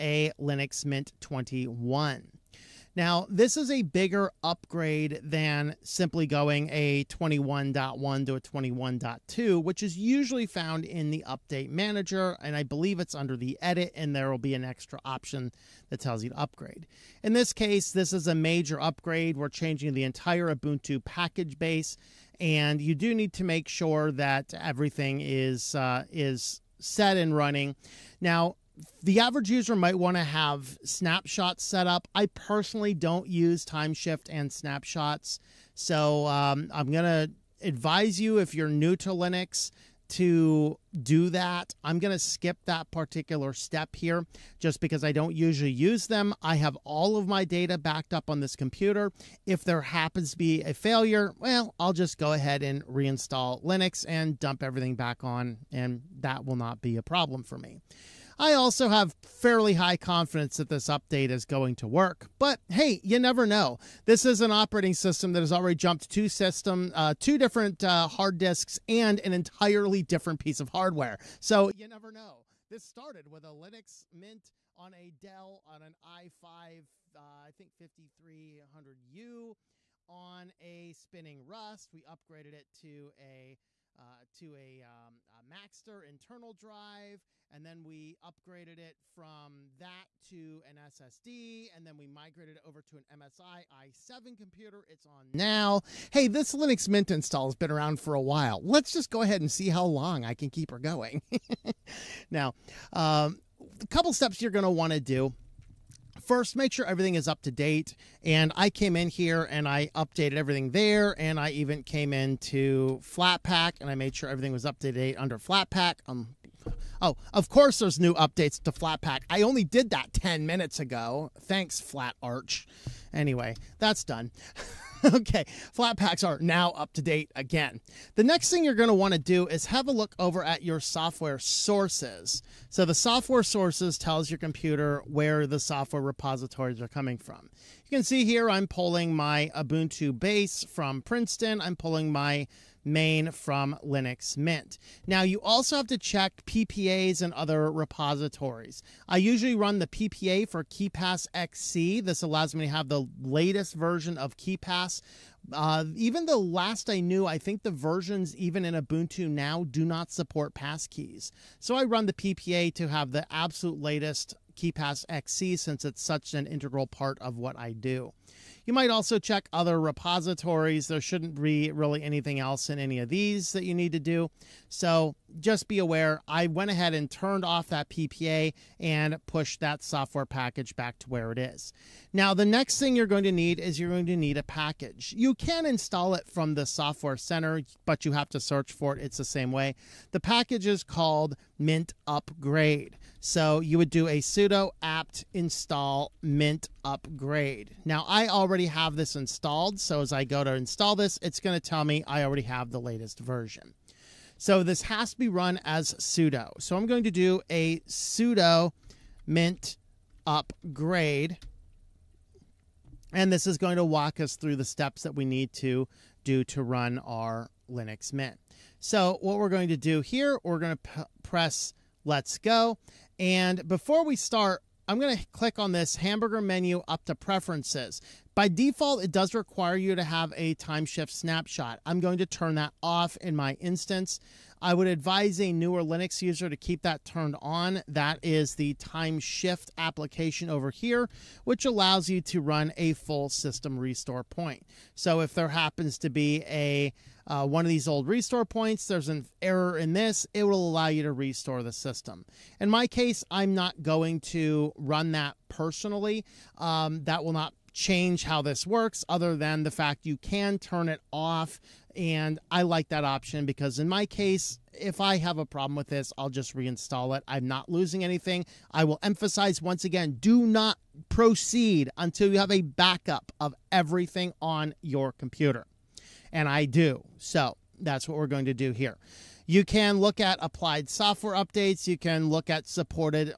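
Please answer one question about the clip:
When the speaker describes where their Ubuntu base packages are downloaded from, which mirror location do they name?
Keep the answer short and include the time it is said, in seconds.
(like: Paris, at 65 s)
Princeton, at 141 s.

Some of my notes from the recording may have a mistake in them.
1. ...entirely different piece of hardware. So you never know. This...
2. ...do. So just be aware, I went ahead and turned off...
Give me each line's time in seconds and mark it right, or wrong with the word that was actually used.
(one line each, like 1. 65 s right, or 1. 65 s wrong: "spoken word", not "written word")
1. 69 s right
2. 173 s right.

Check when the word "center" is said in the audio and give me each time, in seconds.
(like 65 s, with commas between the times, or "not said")
187 s.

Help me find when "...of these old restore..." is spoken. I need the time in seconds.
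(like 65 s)
247 s.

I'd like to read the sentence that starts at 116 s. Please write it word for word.
Um, oh, of course there's new updates to Flatpak.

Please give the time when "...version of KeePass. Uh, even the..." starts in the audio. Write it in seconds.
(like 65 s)
153 s.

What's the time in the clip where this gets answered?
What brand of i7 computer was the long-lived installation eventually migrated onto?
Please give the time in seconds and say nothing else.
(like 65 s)
93 s.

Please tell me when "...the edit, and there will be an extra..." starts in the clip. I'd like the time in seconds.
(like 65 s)
13 s.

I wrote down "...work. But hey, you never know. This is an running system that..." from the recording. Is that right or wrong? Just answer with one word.
wrong.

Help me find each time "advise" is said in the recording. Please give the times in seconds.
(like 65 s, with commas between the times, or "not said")
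37 s, 234 s.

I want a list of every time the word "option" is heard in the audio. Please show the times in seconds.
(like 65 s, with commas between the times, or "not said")
15 s, 263 s.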